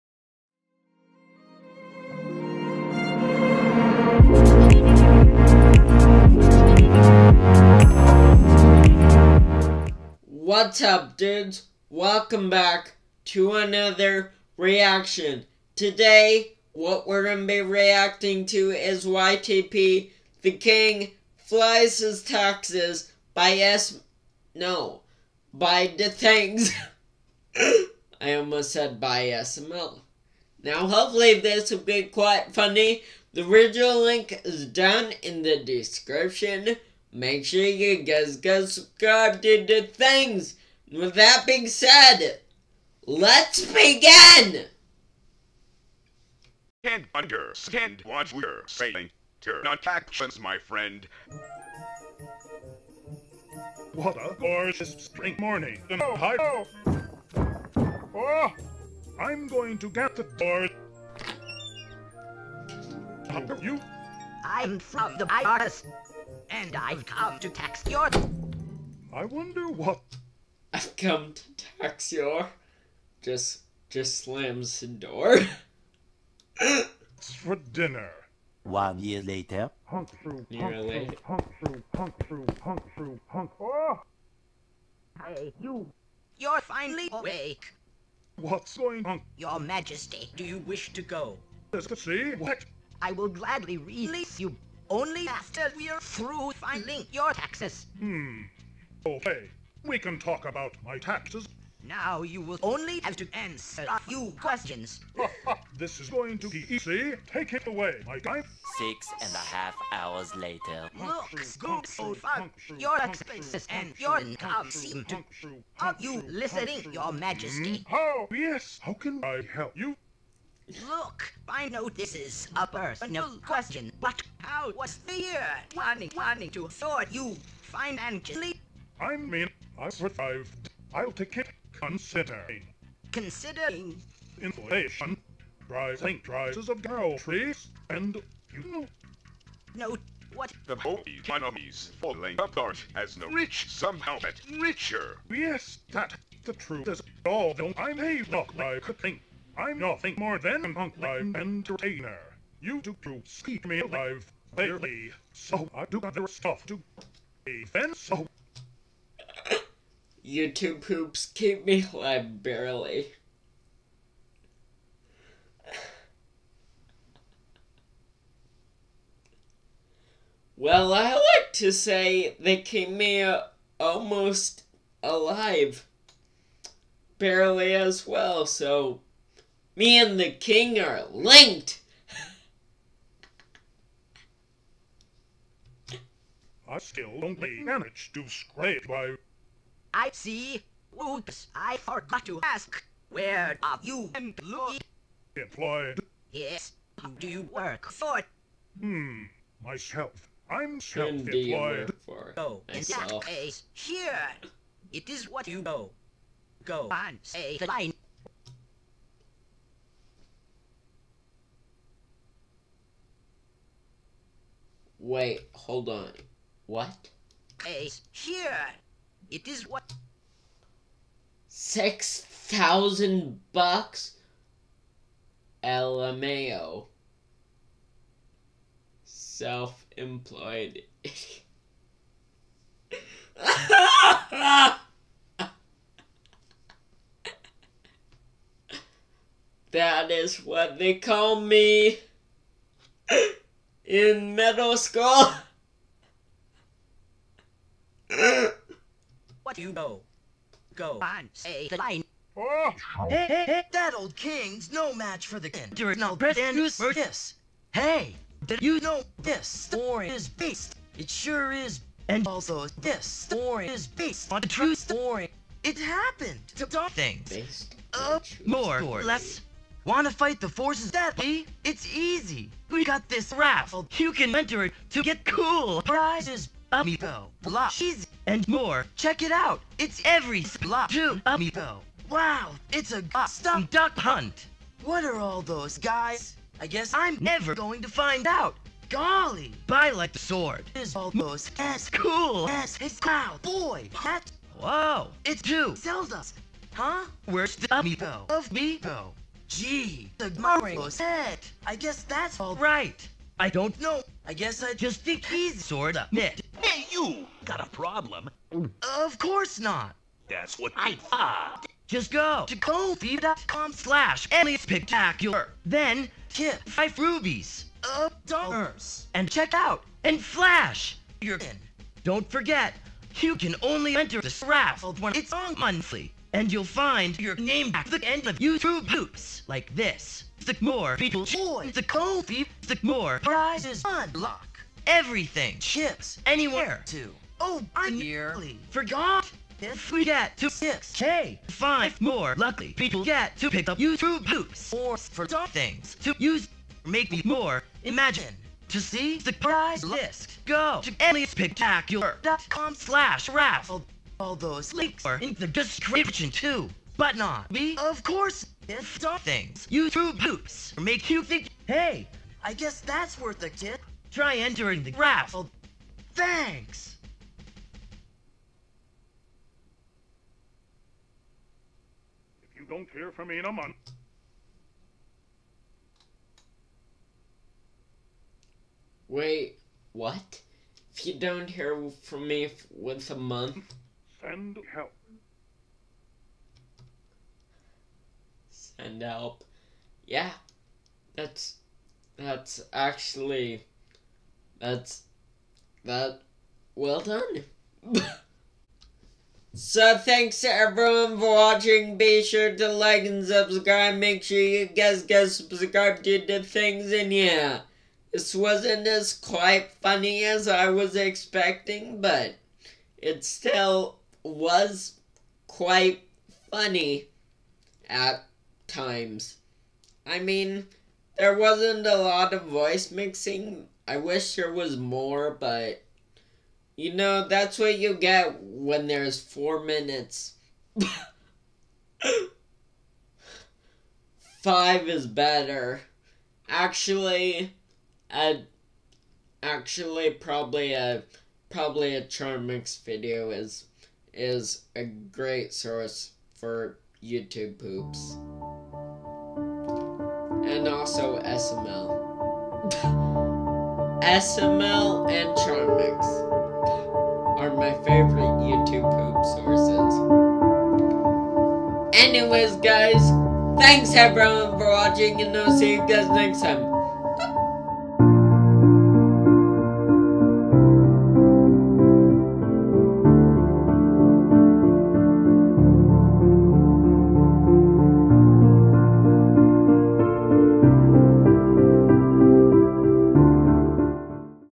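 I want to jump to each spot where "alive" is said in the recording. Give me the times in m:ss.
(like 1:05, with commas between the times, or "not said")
2:33, 2:41, 2:55.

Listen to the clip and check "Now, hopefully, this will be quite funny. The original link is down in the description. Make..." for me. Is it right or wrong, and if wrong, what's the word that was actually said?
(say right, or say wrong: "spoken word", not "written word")
right.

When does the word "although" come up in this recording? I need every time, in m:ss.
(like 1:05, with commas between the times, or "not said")
2:27.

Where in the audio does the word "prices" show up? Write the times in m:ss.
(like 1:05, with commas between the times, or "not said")
2:16.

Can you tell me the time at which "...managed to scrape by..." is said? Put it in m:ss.
3:07.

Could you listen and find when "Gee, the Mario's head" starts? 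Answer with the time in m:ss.
4:59.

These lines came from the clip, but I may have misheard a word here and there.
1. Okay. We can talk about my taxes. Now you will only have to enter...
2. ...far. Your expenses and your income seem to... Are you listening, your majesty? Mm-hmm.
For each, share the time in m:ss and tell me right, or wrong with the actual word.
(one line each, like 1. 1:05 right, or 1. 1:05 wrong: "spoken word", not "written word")
1. 1:39 wrong: "answer", not "enter"
2. 1:52 right.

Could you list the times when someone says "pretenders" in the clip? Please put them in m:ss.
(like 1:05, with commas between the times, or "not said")
4:16.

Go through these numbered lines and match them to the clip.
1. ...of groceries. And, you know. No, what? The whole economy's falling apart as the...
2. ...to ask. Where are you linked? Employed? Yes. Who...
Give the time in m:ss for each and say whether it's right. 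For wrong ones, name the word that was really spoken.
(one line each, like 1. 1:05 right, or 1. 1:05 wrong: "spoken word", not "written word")
1. 2:16 right
2. 3:12 wrong: "employed", not "linked".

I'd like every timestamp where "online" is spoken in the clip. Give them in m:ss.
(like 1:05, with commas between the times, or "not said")
2:30.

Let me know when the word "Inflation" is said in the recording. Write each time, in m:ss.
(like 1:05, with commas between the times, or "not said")
2:14.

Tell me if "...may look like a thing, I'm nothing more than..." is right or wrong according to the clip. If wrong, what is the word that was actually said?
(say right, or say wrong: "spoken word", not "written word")
right.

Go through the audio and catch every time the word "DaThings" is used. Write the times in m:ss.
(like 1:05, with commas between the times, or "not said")
0:25, 6:46.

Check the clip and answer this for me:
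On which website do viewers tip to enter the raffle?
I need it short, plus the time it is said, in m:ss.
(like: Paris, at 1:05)
Ko-fi, at 5:12.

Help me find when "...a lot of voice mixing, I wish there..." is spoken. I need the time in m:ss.
7:01.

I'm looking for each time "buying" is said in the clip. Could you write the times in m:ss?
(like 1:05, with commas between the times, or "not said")
not said.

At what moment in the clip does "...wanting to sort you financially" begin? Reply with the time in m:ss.
2:06.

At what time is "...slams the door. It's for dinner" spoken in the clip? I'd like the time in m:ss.
1:14.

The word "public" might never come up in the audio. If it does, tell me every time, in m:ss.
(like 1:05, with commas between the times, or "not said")
not said.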